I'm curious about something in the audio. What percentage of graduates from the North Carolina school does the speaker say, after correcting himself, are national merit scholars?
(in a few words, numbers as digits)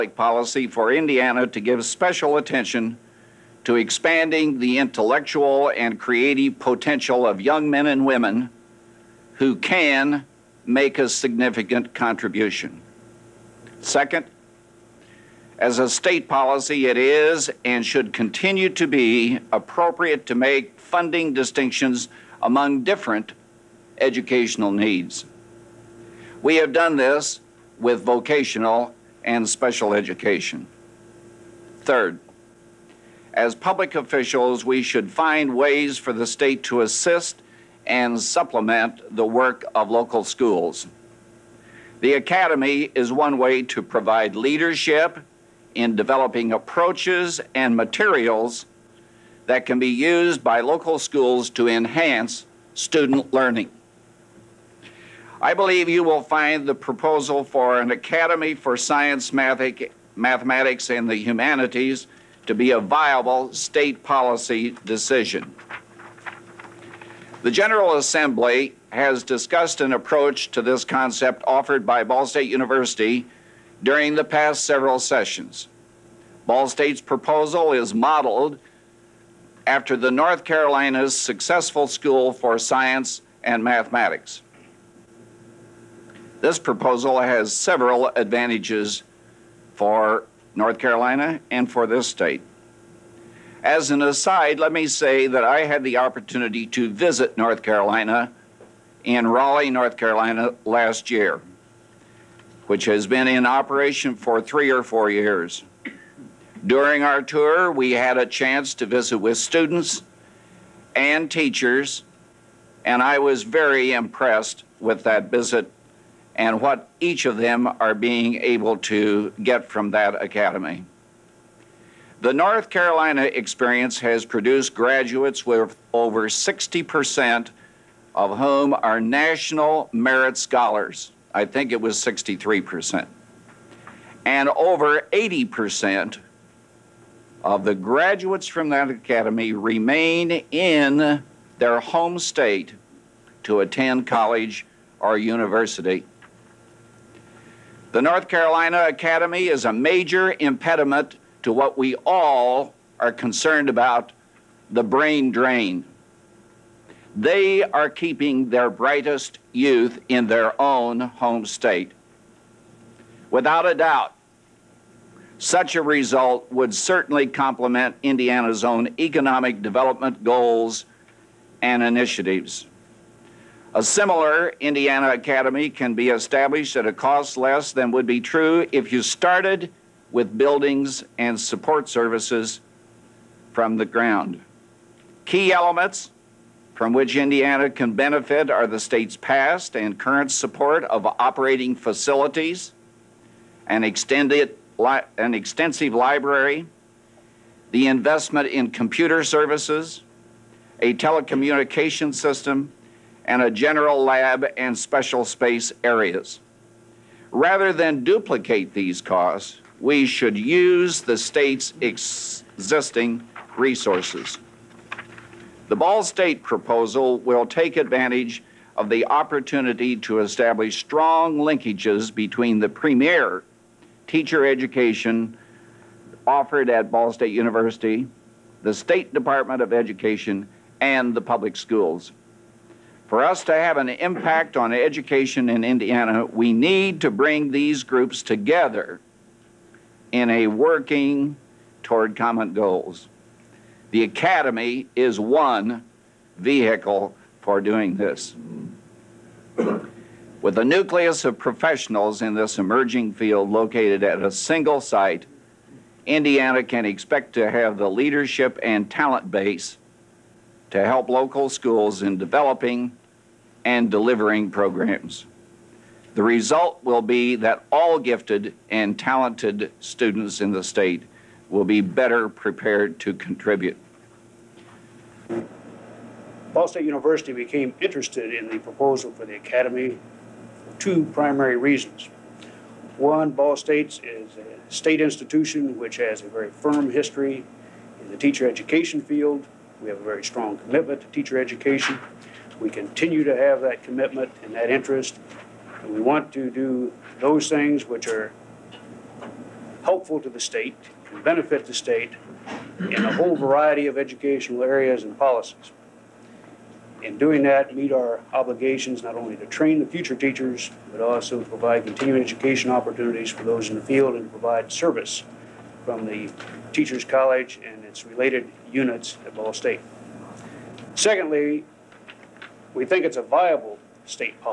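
63%.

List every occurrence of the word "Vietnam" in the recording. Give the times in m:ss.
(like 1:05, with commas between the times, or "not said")
not said.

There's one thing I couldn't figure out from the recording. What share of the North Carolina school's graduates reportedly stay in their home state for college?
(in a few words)
over 80%.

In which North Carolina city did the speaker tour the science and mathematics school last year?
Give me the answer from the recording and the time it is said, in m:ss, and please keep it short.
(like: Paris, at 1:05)
Raleigh, at 1:39.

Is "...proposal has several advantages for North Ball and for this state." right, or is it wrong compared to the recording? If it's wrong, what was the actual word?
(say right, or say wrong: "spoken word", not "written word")
wrong: "Carolina", not "Ball".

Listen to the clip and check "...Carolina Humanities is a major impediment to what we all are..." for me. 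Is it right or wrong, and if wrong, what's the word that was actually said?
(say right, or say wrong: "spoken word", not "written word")
wrong: "Academy", not "Humanities".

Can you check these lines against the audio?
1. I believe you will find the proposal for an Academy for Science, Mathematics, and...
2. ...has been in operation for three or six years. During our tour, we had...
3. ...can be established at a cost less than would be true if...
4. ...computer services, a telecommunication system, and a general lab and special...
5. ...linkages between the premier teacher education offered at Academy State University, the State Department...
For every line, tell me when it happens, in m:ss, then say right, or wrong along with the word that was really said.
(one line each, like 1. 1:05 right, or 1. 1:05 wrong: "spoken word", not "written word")
1. 0:55 right
2. 1:42 wrong: "four", not "six"
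3. 2:55 right
4. 3:18 right
5. 3:41 wrong: "Ball", not "Academy".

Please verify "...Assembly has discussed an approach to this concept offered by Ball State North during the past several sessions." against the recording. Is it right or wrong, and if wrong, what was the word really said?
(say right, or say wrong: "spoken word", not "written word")
wrong: "University", not "North".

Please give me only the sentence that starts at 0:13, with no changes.
Second, as a state policy, it is and should continue to be appropriate to make funding distinctions among different educational needs.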